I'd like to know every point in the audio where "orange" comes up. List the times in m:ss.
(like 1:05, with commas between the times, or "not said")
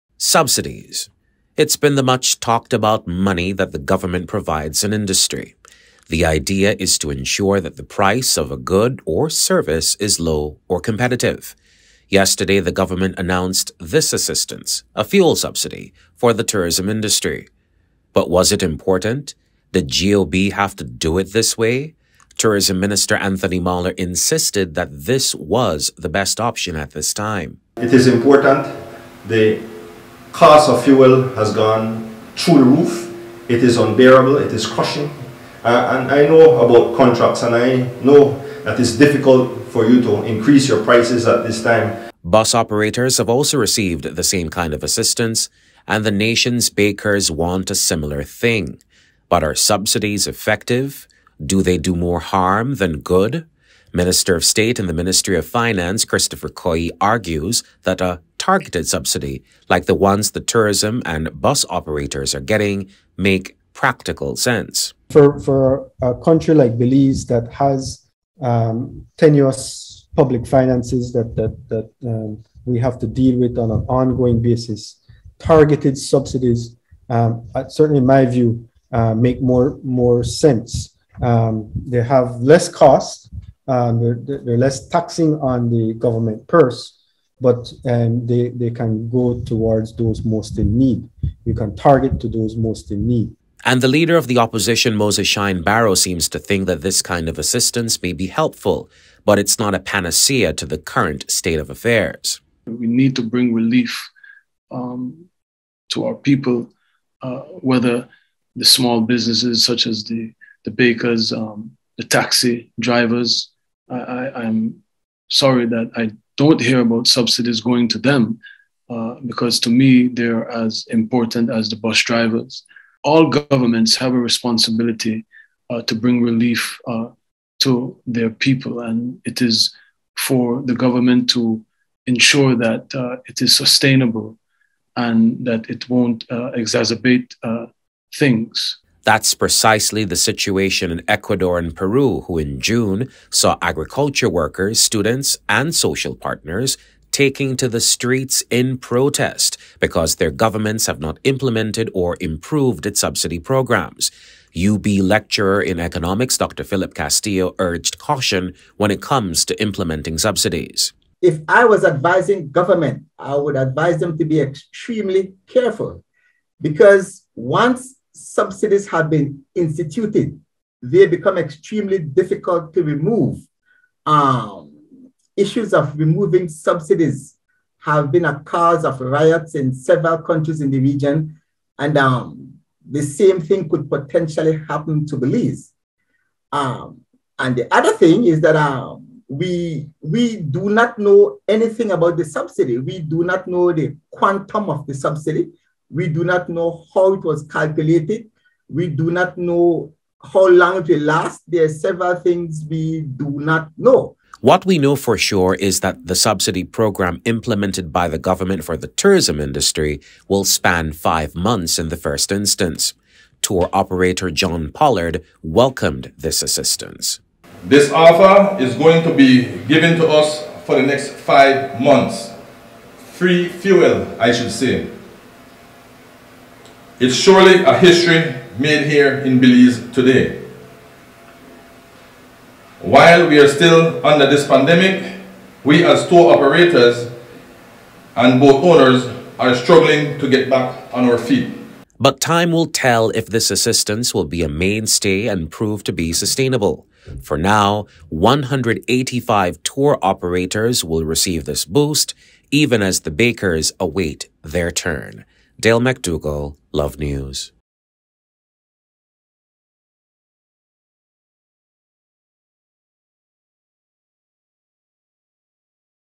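not said.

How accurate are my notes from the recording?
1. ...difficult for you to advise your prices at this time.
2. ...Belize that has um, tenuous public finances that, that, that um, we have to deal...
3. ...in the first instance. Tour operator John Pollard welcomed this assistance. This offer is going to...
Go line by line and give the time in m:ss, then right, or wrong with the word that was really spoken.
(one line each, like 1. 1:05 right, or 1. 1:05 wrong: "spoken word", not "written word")
1. 0:38 wrong: "increase", not "advise"
2. 1:06 right
3. 3:31 right.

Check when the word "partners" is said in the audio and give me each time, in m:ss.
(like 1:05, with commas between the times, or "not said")
2:26.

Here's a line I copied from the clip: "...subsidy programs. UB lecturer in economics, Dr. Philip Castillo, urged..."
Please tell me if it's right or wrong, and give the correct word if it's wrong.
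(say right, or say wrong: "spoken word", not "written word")
right.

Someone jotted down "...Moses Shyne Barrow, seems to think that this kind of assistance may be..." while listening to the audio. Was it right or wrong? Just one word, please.
right.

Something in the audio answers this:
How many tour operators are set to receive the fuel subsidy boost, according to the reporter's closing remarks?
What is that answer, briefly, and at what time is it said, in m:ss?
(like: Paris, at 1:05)
185, at 4:08.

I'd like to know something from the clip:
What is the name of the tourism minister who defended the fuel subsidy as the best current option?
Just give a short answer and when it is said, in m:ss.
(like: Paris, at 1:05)
Anthony Mahler, at 0:23.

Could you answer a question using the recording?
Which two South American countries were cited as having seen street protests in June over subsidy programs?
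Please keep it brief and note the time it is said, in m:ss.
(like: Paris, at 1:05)
Ecuador and Peru, at 2:21.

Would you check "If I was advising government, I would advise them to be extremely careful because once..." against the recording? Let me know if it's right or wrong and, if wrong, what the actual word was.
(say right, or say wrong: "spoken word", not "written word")
right.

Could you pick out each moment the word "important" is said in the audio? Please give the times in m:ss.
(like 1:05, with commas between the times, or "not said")
0:18, 0:28, 2:00.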